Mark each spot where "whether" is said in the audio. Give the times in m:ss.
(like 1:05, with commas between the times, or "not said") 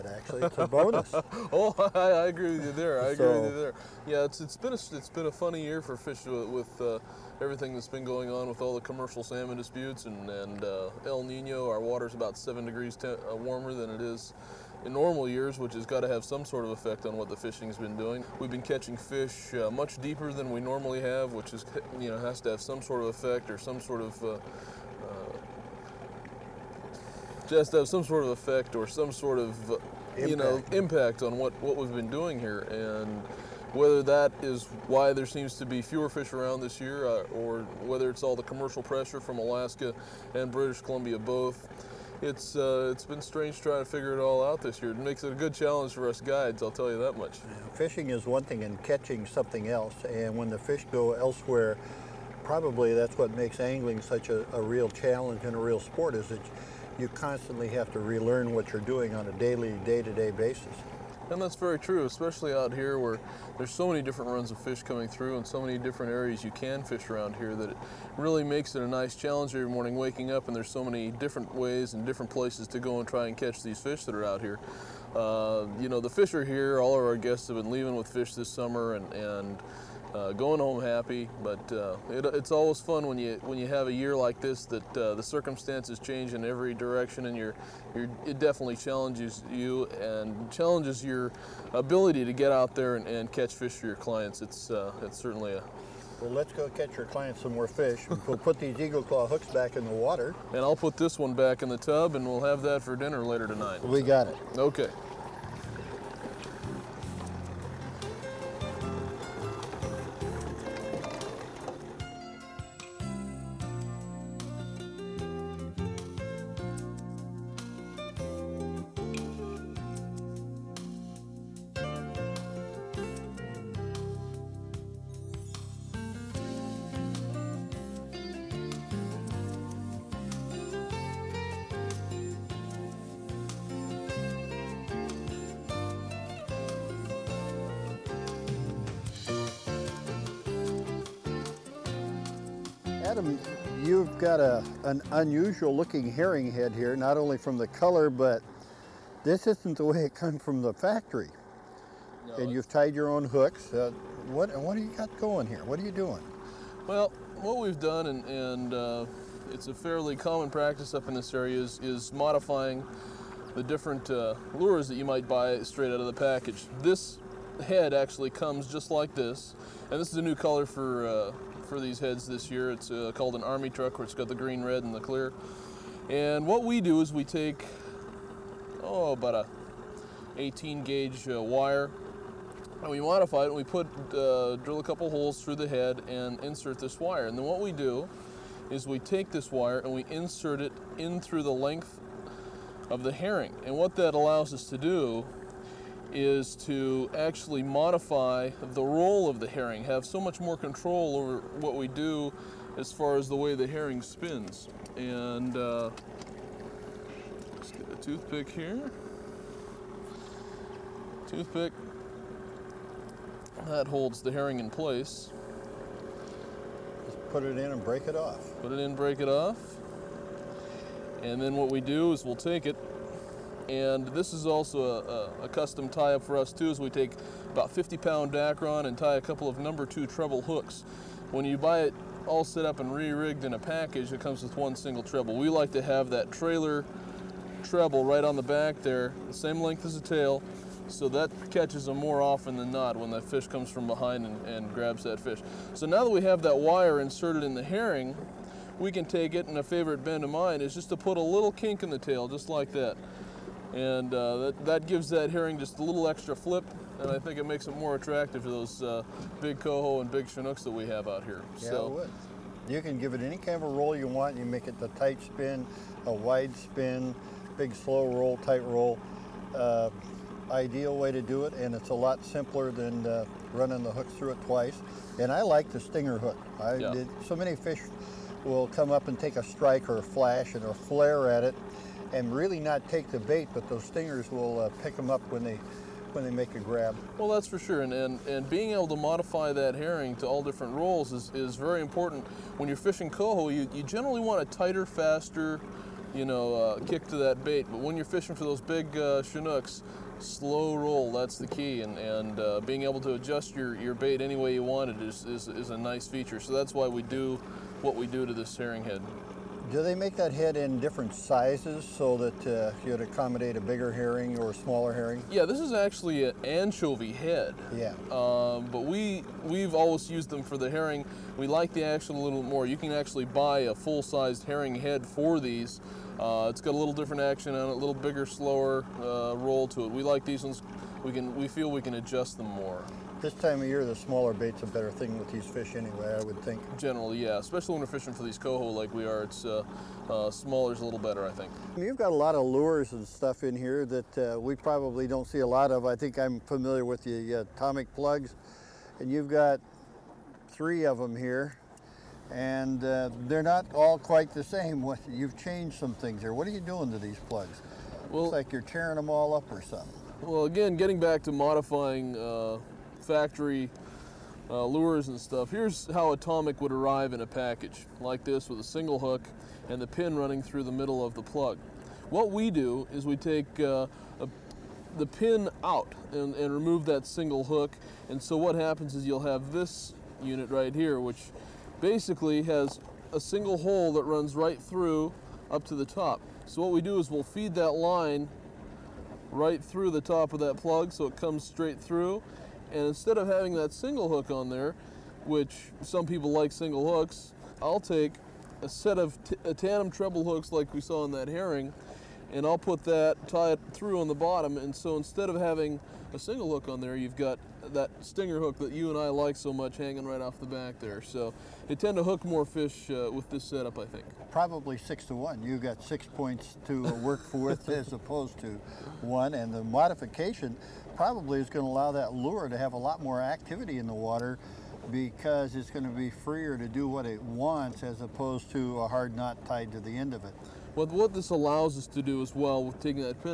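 0:33, 0:37.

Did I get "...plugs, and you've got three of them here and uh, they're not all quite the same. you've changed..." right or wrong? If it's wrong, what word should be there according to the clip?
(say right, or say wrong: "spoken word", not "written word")
right.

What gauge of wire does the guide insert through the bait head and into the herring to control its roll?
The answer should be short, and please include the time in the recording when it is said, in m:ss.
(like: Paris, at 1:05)
18 gauge, at 3:00.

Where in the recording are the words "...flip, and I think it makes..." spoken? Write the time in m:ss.
4:16.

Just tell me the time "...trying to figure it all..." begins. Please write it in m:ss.
0:43.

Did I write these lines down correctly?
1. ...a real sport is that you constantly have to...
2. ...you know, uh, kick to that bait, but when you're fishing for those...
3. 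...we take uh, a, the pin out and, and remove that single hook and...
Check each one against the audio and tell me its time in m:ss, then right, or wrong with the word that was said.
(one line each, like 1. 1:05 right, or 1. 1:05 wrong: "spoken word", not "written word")
1. 0:55 right
2. 4:56 right
3. 6:13 right.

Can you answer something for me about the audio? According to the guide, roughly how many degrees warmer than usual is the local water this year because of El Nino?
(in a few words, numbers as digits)
7 degrees.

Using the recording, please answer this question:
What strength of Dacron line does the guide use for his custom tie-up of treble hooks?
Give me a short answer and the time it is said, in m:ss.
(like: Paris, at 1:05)
50-pound, at 3:47.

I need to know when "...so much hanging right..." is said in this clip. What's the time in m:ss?
6:49.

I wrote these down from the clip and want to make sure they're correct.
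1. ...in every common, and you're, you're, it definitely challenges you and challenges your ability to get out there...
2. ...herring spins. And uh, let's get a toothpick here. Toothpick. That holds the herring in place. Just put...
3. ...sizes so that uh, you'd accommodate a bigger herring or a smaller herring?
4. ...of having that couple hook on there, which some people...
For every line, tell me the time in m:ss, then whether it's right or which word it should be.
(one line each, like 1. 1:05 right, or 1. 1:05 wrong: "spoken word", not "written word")
1. 1:26 wrong: "direction", not "common"
2. 3:23 right
3. 5:11 right
4. 6:33 wrong: "single", not "couple".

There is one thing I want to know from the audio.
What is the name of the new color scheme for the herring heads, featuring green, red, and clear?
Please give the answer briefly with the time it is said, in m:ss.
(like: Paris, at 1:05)
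army truck, at 2:53.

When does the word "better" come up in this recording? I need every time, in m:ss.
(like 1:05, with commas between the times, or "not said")
5:34, 5:41.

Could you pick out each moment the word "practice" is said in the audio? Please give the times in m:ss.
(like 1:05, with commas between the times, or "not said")
2:40.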